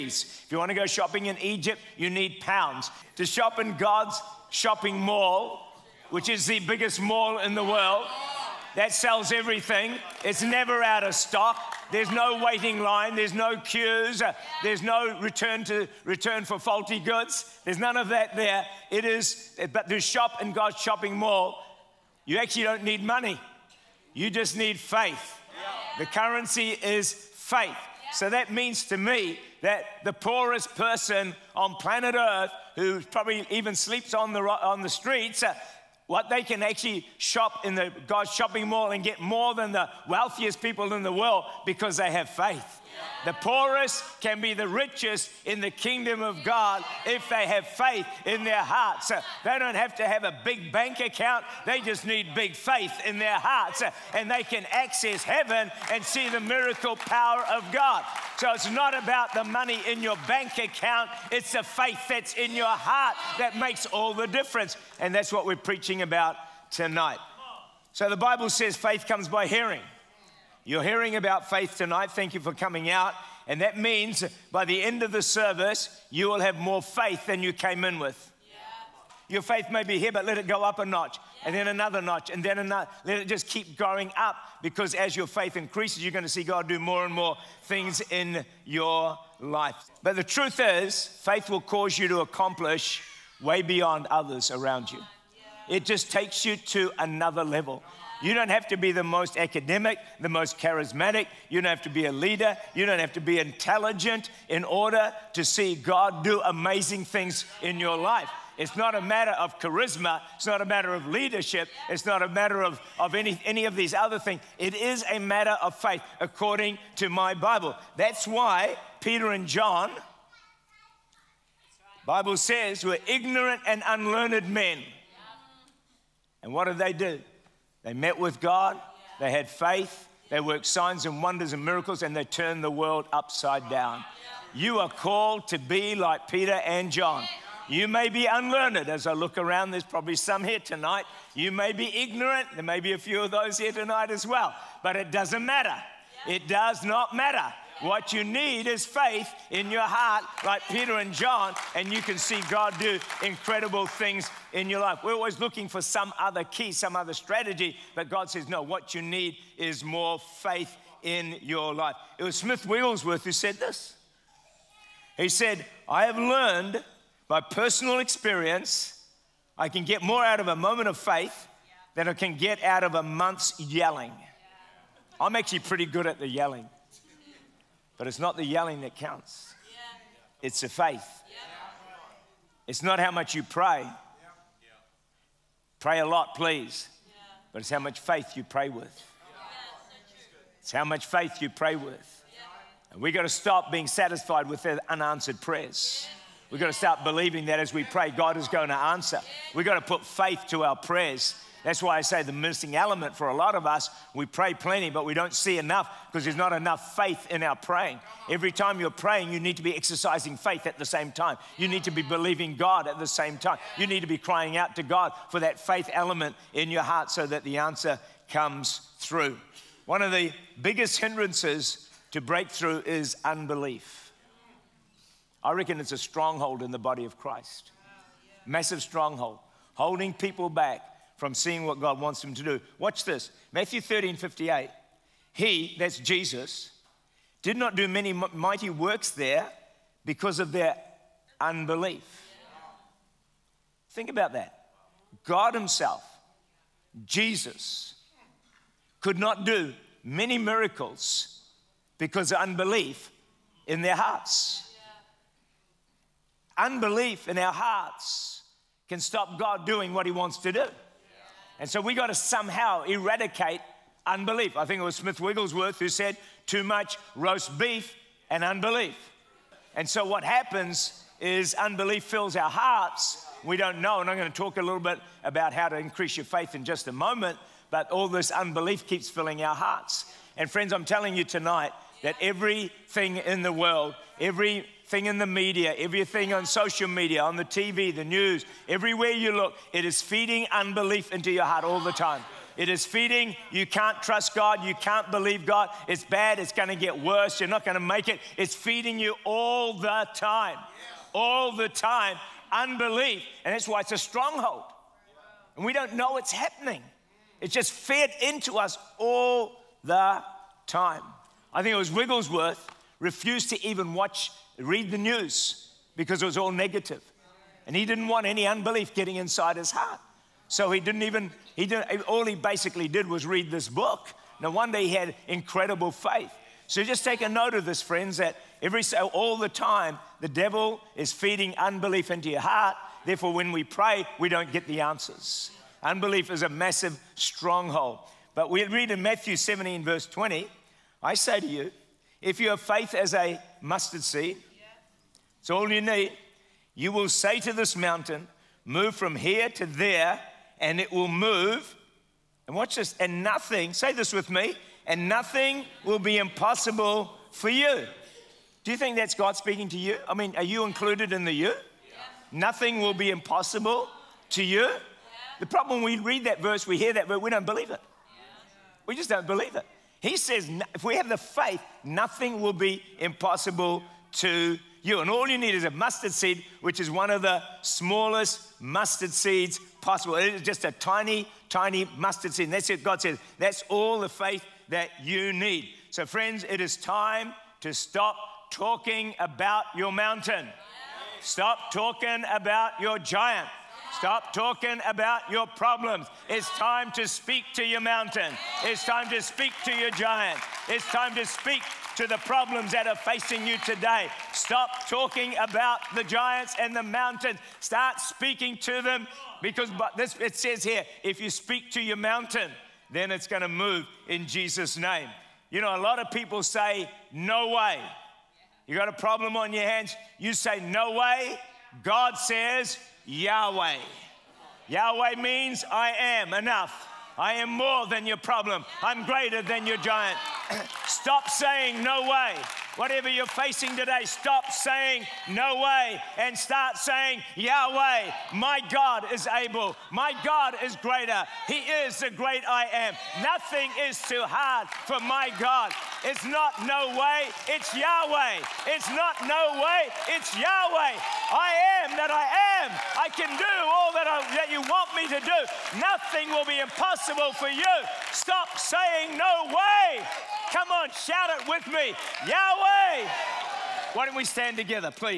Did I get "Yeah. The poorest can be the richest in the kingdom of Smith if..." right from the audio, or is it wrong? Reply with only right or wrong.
wrong.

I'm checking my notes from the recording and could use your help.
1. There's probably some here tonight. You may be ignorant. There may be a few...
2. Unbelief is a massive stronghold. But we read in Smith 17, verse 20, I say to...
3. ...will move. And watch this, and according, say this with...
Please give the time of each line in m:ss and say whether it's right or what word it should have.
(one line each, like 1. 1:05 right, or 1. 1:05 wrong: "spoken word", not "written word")
1. 2:19 right
2. 5:35 wrong: "Matthew", not "Smith"
3. 5:50 wrong: "nothing", not "according".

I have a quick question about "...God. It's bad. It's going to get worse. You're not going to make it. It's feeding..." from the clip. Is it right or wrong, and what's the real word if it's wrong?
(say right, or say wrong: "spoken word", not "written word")
right.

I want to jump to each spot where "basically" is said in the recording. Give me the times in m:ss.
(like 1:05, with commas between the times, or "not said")
5:22.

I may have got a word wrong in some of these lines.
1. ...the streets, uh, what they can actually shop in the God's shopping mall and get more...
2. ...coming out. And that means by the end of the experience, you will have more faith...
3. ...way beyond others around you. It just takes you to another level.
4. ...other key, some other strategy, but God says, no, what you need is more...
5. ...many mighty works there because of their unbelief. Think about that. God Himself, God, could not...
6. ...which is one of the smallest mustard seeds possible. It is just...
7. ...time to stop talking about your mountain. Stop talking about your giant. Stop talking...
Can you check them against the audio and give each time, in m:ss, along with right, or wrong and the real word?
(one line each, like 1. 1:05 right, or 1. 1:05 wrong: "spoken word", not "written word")
1. 0:34 right
2. 1:12 wrong: "service", not "experience"
3. 1:33 right
4. 2:36 right
5. 3:57 wrong: "Jesus", not "God"
6. 6:16 right
7. 6:26 right.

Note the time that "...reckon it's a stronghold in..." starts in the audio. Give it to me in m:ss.
3:45.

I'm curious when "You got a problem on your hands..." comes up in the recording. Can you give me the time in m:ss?
6:58.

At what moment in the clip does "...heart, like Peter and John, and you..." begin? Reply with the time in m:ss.
2:29.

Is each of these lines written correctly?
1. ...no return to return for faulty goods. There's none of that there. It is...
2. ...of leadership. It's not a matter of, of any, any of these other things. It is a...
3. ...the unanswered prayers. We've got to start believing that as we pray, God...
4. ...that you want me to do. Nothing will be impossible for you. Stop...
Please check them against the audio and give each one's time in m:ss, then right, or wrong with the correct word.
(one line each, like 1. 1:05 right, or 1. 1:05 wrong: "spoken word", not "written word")
1. 0:14 right
2. 1:50 right
3. 3:14 right
4. 7:34 right.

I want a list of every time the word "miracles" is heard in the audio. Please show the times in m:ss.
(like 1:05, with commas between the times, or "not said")
0:56, 2:11, 4:10.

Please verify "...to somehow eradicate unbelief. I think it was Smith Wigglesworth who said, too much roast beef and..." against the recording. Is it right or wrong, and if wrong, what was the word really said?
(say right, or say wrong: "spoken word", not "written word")
right.